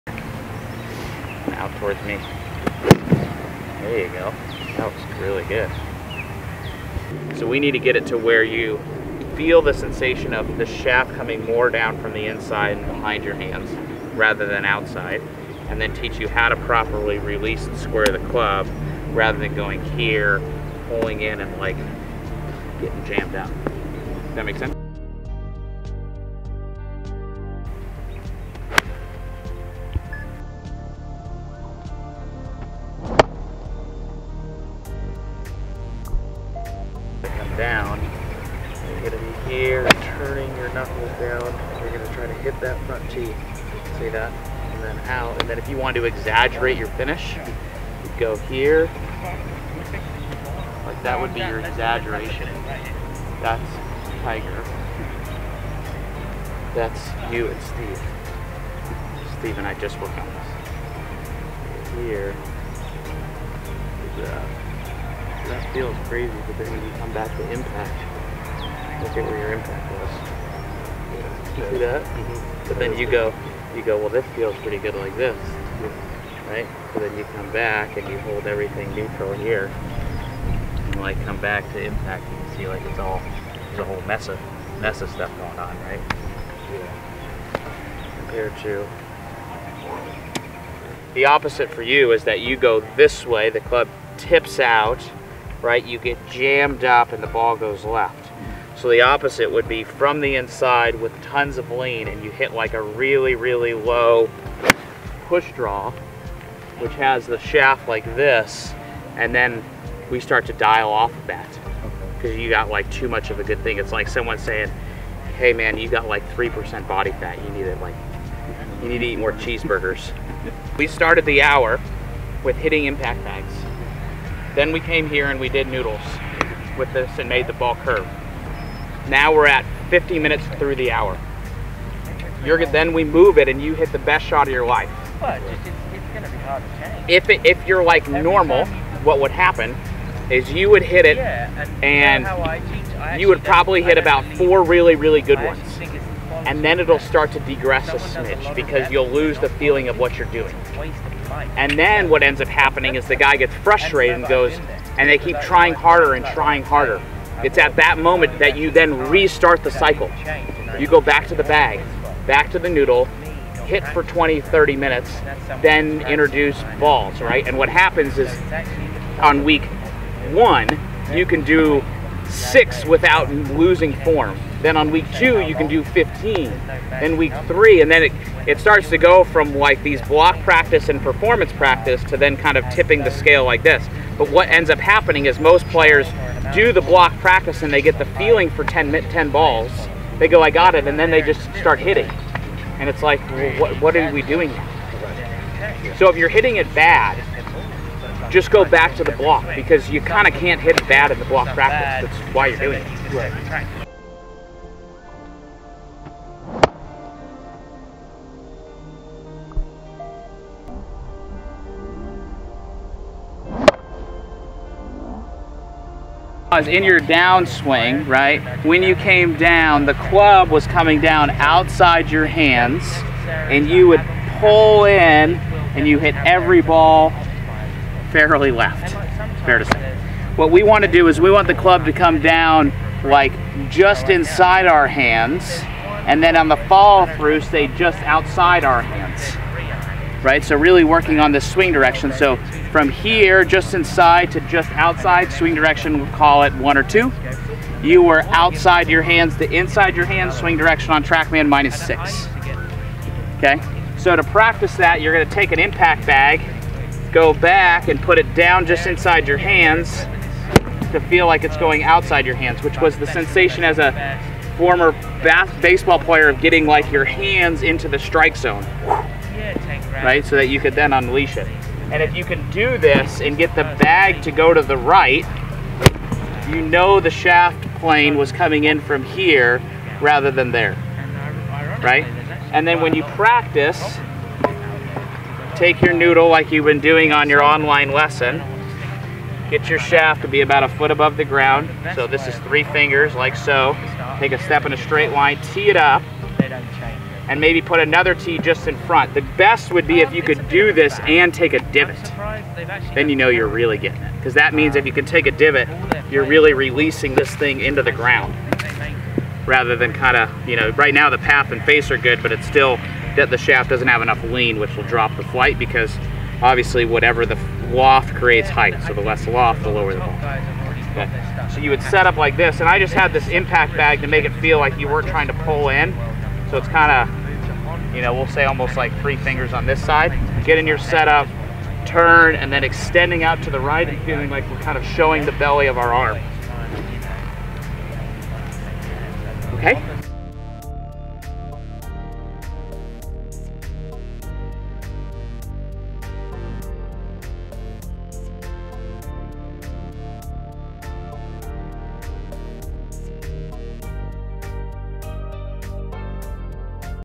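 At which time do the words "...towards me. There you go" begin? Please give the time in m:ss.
0:01.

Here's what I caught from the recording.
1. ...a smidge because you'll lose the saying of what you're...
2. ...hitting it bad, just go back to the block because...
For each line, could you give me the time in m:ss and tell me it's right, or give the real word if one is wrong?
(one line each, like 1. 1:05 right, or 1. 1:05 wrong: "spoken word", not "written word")
1. 2:27 wrong: "feeling", not "saying"
2. 3:16 right.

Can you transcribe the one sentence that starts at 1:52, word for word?
Because you got like too much of a good thing.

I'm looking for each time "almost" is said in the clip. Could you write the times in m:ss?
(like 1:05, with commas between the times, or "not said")
5:28.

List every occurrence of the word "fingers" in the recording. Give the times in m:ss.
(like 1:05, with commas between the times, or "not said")
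4:52, 5:29.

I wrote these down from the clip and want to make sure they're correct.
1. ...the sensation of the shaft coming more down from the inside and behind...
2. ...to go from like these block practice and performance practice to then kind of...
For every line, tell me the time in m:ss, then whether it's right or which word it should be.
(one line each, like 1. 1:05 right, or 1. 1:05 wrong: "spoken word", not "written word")
1. 0:09 right
2. 2:58 right.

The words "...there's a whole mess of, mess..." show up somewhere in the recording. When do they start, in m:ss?
1:23.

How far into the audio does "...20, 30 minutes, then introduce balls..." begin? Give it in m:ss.
2:44.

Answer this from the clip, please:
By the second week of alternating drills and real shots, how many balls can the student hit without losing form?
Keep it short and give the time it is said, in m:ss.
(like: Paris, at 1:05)
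15, at 2:55.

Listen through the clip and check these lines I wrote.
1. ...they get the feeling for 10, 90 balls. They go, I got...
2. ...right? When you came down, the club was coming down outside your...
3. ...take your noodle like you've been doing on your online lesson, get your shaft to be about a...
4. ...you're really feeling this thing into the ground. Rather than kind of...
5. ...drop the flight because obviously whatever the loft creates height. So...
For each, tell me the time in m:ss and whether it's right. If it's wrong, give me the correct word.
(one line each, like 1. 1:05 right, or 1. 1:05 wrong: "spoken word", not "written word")
1. 3:07 wrong: "10", not "90"
2. 3:38 right
3. 4:45 right
4. 5:06 wrong: "releasing", not "feeling"
5. 5:14 right.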